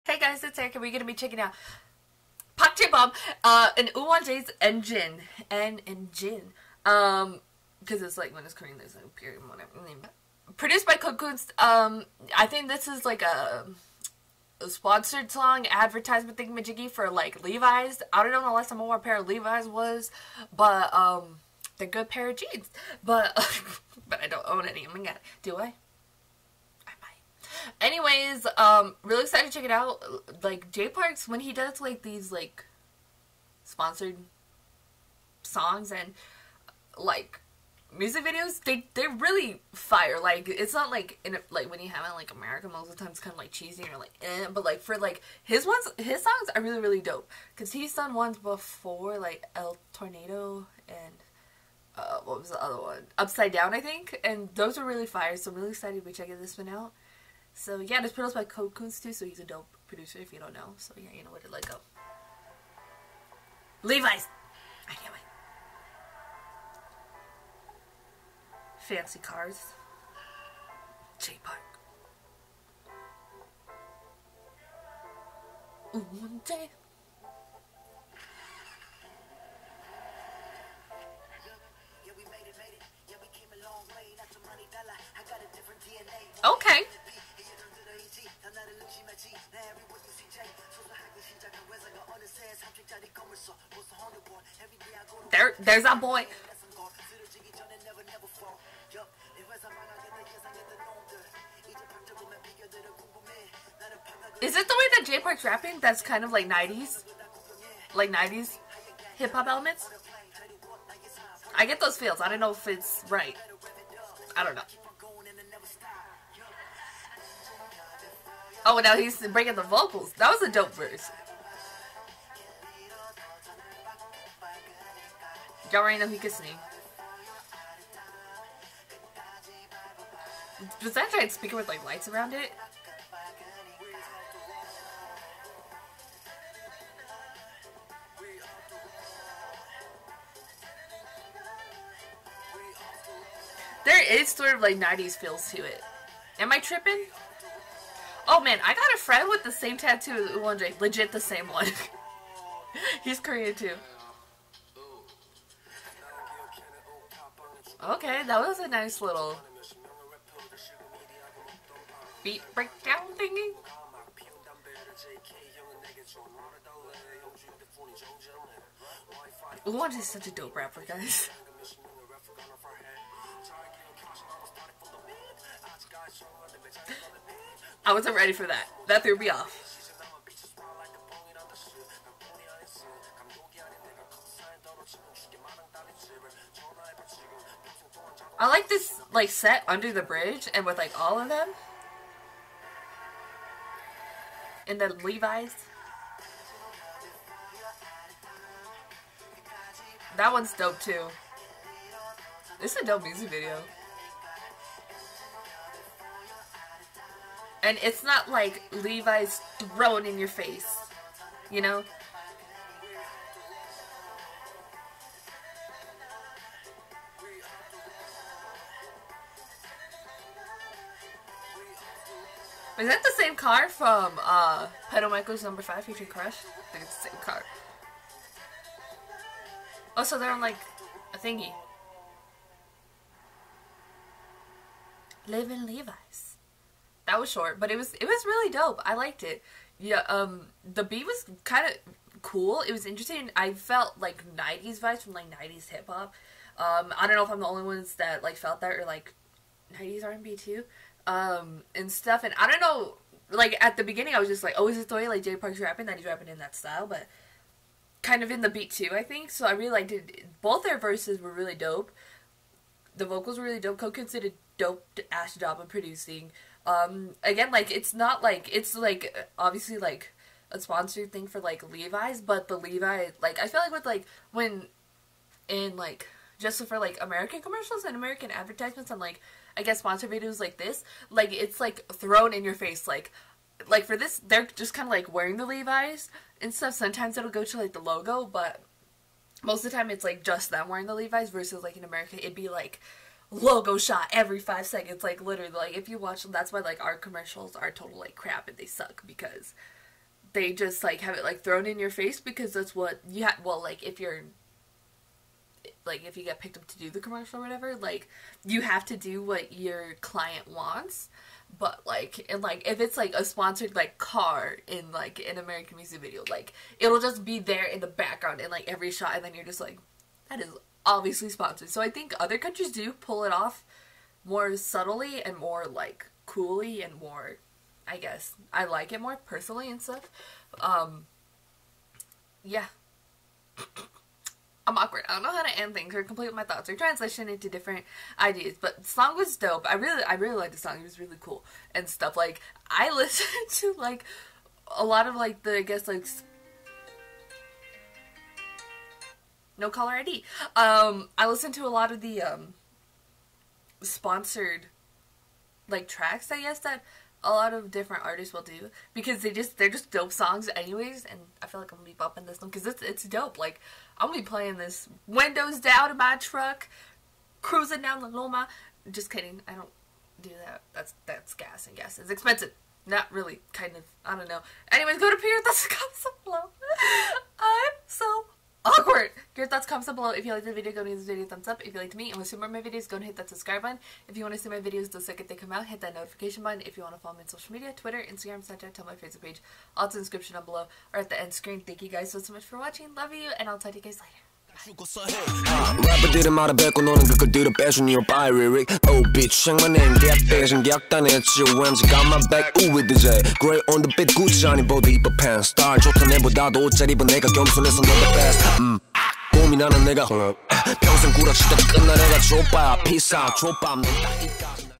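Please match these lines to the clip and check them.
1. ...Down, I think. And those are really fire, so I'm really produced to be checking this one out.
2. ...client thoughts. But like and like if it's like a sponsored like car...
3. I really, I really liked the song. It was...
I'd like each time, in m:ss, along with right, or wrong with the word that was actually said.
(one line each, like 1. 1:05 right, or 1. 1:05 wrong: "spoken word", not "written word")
1. 0:53 wrong: "excited", not "produced"
2. 5:10 wrong: "wants", not "thoughts"
3. 5:39 right.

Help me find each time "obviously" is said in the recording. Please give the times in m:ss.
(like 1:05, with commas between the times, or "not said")
4:29, 5:20.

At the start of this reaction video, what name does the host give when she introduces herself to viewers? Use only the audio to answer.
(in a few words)
Erika.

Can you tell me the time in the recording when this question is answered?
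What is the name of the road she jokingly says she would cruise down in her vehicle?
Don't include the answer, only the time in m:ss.
6:08.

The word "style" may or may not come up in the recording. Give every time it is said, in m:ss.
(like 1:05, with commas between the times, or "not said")
4:16.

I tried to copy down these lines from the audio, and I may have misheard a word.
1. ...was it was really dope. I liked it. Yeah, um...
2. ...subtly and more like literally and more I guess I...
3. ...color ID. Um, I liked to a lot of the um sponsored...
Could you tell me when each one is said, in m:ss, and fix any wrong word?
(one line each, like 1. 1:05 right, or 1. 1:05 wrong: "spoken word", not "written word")
1. 3:57 right
2. 5:24 wrong: "coolly", not "literally"
3. 5:49 wrong: "listened", not "liked".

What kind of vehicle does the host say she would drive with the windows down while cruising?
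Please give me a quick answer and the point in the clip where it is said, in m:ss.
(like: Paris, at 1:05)
truck, at 6:06.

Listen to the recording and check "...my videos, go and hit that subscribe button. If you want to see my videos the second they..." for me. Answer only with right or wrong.
right.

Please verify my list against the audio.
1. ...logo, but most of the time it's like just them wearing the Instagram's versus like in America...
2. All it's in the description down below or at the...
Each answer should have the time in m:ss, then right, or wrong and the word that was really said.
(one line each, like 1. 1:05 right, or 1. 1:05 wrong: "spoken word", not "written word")
1. 4:47 wrong: "Levi", not "Instagram"
2. 6:29 right.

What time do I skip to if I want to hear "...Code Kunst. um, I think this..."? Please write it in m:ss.
0:10.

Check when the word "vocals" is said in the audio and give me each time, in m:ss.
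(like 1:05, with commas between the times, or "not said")
1:59, 4:23.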